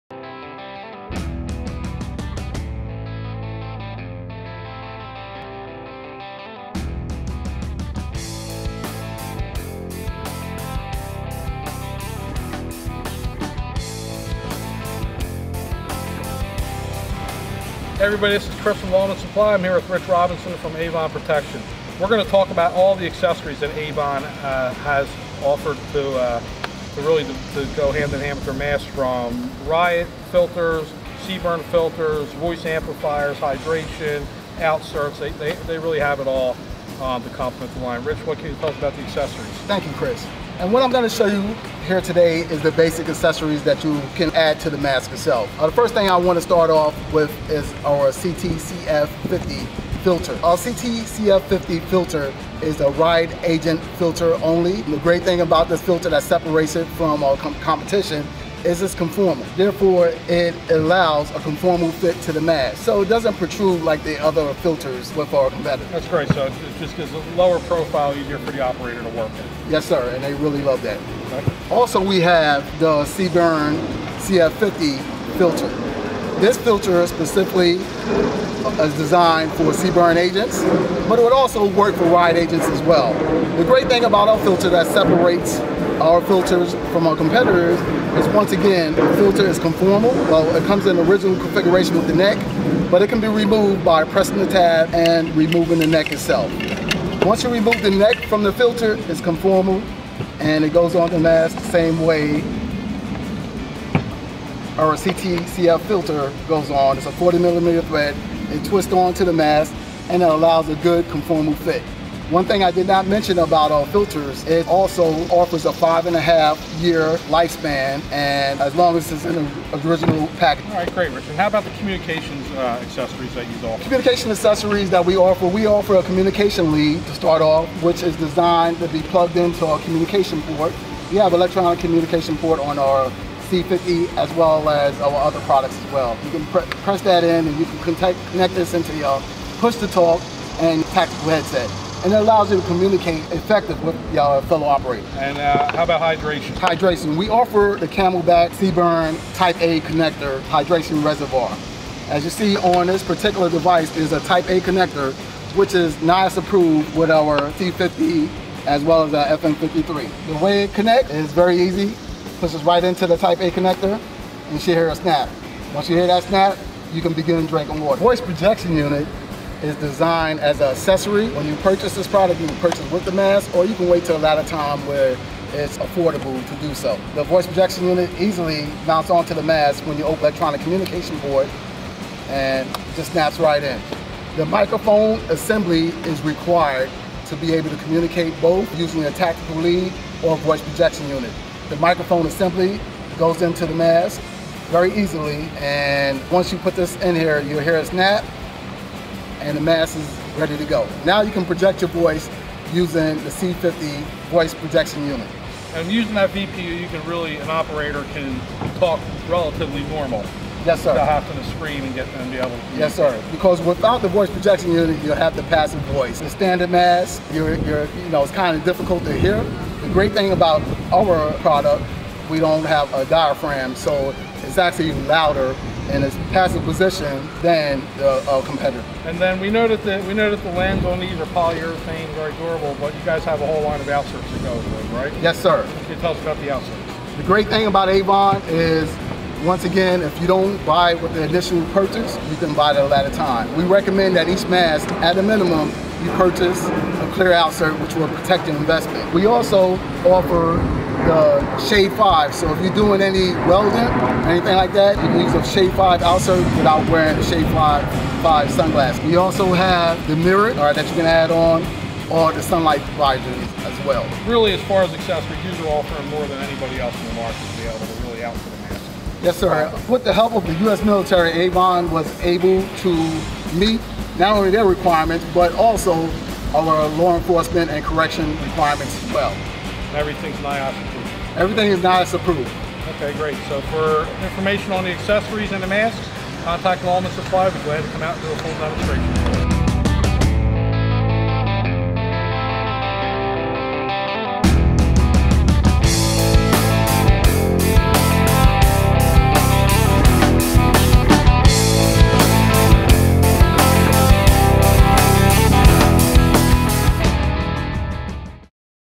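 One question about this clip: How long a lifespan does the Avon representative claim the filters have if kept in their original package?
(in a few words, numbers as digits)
5 and a half years.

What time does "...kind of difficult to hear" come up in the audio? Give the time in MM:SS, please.
03:38.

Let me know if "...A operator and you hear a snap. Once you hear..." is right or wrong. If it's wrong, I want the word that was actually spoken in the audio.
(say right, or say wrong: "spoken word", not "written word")
wrong: "connector", not "operator".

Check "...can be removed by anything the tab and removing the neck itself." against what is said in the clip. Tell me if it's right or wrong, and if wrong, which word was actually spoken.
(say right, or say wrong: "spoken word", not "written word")
wrong: "pressing", not "anything".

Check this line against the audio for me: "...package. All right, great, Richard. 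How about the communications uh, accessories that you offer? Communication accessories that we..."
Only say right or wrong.
right.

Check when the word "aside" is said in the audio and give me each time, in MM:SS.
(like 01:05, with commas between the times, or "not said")
not said.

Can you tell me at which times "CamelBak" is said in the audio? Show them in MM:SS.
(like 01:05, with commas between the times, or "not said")
02:27.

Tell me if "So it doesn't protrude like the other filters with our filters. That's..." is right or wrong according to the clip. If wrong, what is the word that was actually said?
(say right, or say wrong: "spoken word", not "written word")
wrong: "competitors", not "filters".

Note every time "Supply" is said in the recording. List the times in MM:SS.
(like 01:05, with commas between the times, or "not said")
00:19, 04:47.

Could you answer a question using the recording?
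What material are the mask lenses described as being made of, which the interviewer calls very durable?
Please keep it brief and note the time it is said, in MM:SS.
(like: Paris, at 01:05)
Polyurethane, at 03:51.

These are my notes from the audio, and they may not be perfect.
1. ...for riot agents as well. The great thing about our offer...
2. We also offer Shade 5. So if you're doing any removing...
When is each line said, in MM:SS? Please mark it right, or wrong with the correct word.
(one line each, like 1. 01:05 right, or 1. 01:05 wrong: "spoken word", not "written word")
1. 01:21 wrong: "filter", not "offer"
2. 04:09 wrong: "welding", not "removing".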